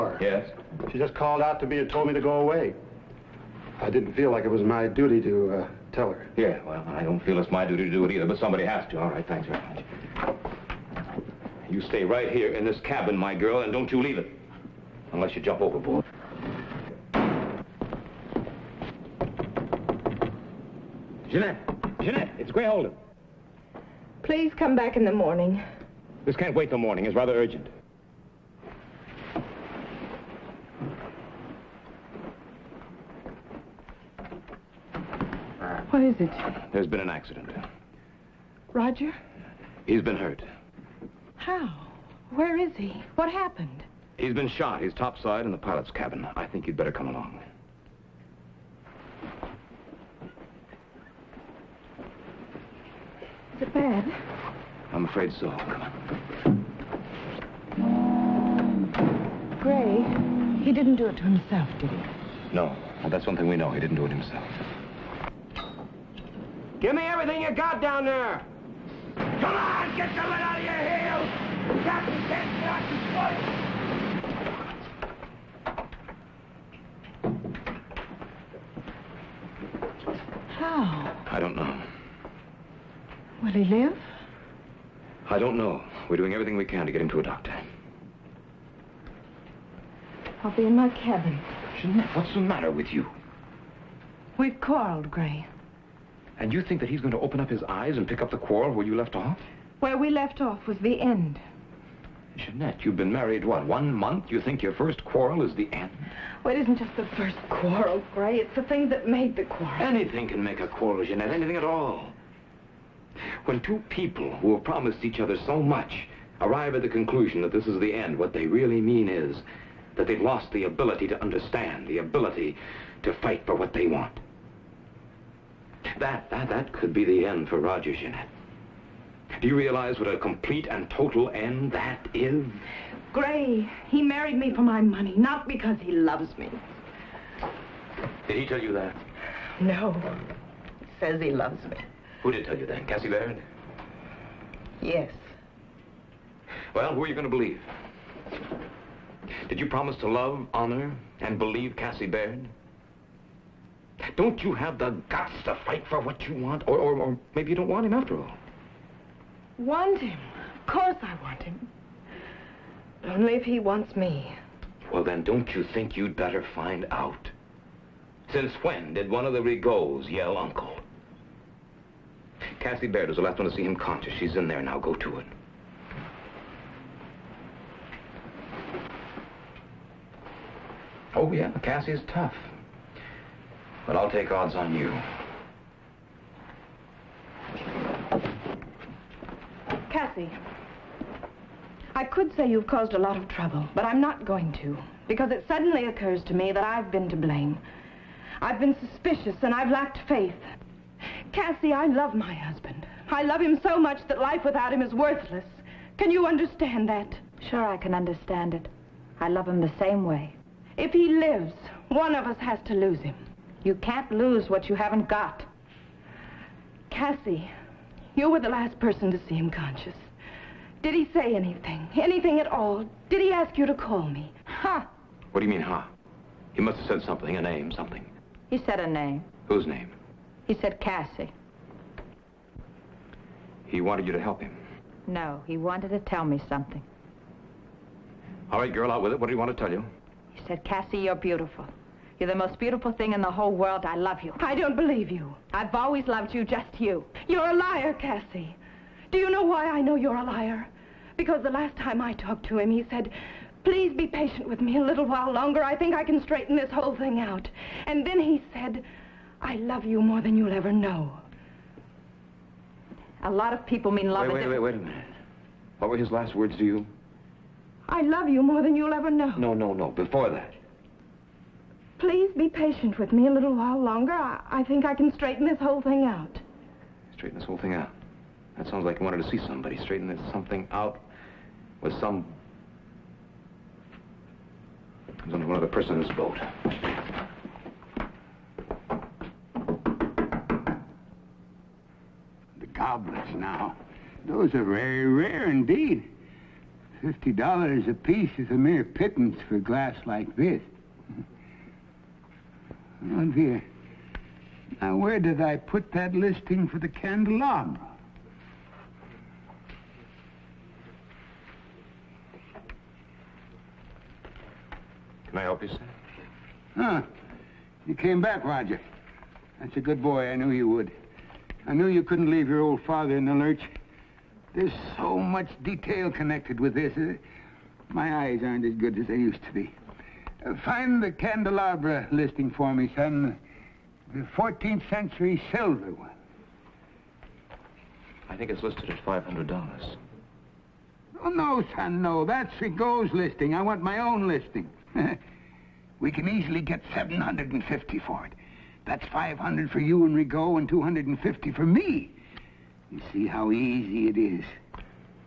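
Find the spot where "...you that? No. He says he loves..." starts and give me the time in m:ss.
2:18.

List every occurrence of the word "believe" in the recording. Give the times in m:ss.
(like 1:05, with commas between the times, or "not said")
2:27, 2:31, 4:04.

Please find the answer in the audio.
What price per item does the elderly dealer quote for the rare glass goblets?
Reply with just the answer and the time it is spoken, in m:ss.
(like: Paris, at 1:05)
$50, at 4:57.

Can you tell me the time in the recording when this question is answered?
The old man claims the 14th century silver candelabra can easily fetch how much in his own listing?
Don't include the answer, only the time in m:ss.
5:46.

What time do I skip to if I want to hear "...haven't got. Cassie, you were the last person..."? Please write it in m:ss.
3:34.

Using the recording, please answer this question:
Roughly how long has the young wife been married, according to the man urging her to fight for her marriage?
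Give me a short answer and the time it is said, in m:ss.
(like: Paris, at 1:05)
One month, at 1:43.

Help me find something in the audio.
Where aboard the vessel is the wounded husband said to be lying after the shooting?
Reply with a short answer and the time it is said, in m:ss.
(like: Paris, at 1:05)
Pilot's cabin, at 0:45.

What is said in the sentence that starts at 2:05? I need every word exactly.
That, that, that could be the end for Roger Jeanette.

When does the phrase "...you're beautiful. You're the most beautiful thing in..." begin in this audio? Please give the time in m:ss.
4:00.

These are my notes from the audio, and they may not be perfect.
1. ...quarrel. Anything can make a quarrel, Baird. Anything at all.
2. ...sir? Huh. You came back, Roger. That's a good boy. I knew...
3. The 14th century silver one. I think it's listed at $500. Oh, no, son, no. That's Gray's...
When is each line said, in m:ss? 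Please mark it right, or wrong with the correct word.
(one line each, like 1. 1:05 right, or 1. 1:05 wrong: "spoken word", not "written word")
1. 1:49 wrong: "Jeanette", not "Baird"
2. 5:15 right
3. 5:34 wrong: "Rigaud", not "Gray".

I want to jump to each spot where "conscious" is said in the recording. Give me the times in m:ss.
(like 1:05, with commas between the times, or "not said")
2:53, 3:39.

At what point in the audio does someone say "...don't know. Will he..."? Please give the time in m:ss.
1:21.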